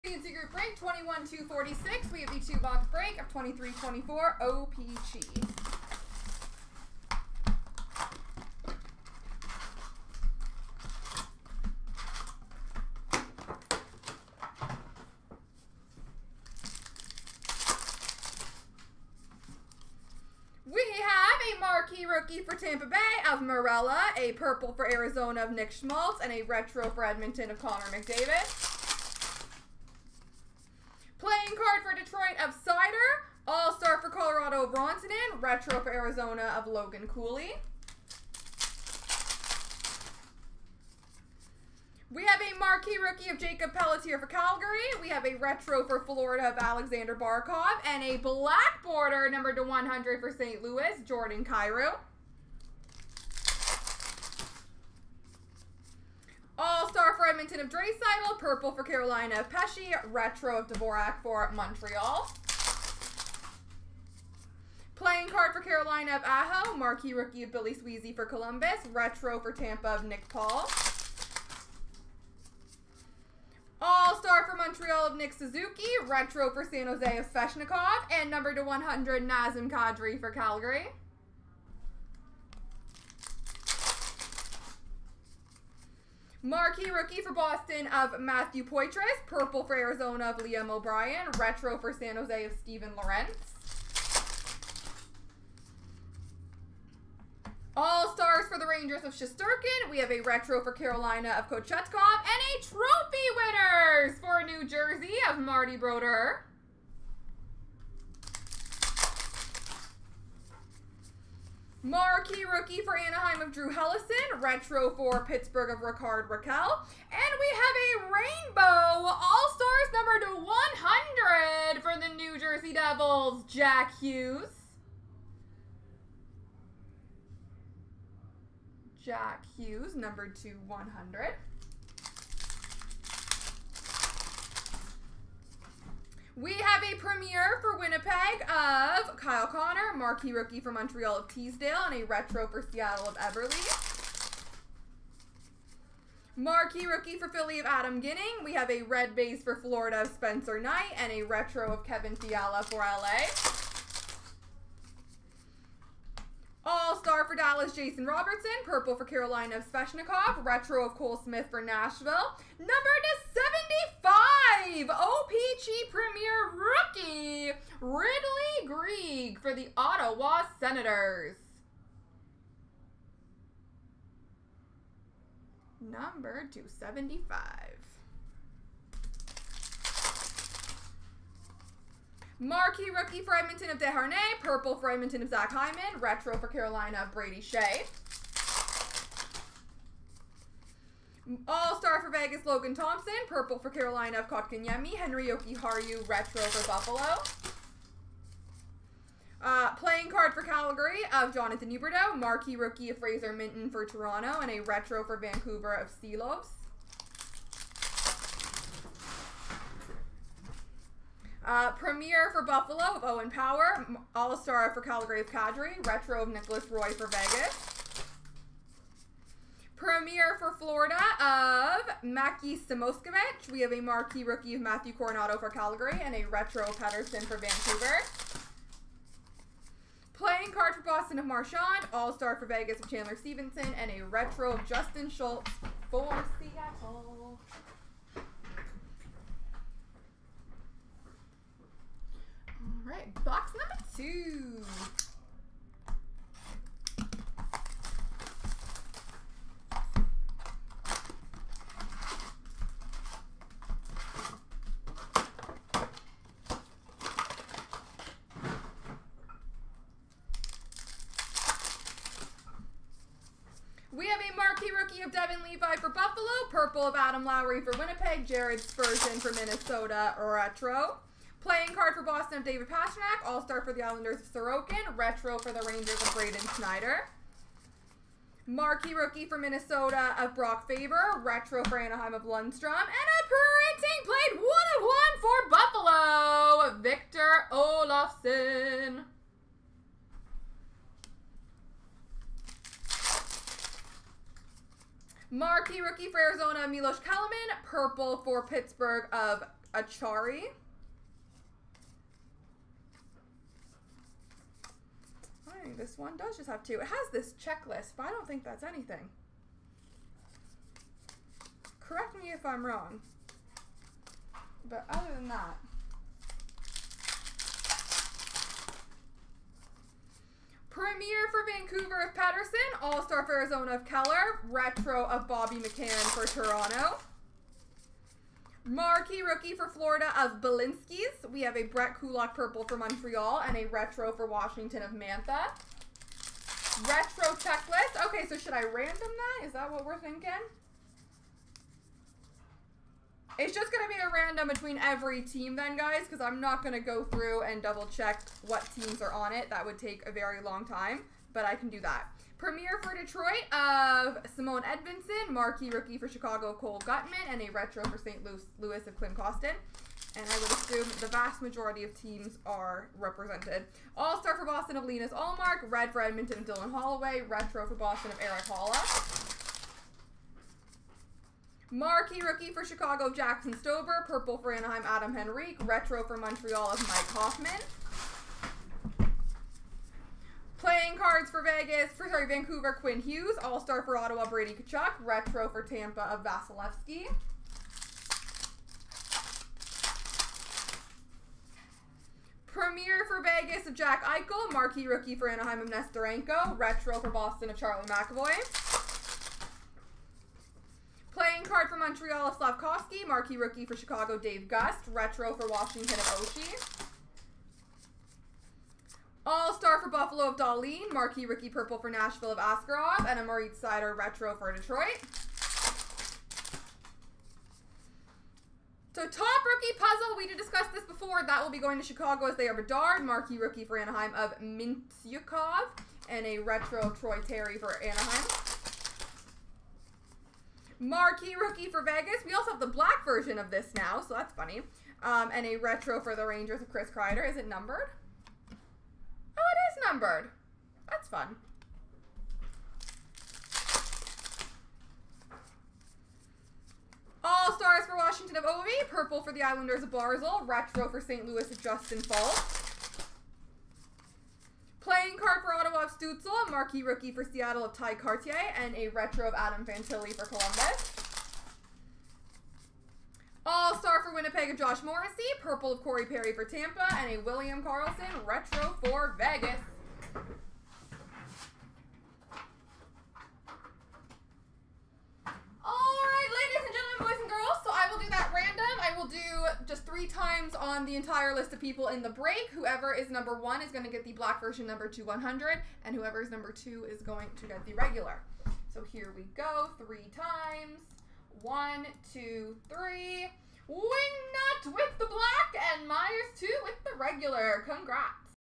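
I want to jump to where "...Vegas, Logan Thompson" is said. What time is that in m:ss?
3:12.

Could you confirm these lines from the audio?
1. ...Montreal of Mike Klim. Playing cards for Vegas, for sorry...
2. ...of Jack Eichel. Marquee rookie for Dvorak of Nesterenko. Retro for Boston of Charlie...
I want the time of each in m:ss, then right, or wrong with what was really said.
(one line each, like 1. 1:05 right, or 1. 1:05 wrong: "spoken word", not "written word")
1. 6:16 wrong: "Hoffman", not "Klim"
2. 6:33 wrong: "Anaheim", not "Dvorak".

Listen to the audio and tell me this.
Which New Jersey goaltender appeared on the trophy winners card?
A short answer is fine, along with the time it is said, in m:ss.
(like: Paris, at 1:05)
Marty Brodeur, at 1:45.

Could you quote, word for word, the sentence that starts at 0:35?
retro for Arizona of Logan Cooley.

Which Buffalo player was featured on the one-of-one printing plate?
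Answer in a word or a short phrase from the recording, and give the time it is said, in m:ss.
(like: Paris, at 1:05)
Victor Olofsson, at 4:46.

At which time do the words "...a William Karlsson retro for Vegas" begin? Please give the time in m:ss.
7:47.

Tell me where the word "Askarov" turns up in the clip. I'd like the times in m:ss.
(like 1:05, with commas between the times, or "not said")
6:52.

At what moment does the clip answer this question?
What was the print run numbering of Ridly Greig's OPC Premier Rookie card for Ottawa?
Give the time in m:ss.
2:44.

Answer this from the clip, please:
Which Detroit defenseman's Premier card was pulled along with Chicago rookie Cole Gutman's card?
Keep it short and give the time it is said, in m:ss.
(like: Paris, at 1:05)
Simon Edvinsson, at 5:54.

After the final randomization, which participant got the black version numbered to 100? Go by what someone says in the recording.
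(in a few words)
Wingnut.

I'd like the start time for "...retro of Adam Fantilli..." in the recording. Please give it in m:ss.
7:38.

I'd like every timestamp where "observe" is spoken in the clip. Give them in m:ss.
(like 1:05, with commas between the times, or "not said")
not said.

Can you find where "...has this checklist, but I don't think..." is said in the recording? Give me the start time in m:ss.
5:06.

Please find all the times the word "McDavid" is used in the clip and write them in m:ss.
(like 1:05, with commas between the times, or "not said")
0:27.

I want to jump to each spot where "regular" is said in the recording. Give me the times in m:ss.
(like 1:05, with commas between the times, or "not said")
8:07, 8:16.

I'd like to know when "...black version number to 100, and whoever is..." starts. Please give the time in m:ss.
8:04.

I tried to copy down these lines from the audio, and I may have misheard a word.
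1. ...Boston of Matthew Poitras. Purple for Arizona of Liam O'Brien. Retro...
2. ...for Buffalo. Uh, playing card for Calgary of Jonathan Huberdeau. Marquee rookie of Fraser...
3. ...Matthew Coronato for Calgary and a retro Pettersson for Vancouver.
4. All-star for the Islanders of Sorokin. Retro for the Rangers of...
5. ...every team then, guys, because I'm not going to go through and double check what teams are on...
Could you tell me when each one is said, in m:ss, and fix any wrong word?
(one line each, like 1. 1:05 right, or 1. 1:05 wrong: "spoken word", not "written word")
1. 1:27 right
2. 3:16 right
3. 3:44 right
4. 4:33 right
5. 5:44 right.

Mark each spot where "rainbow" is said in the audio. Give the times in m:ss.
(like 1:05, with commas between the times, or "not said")
1:58.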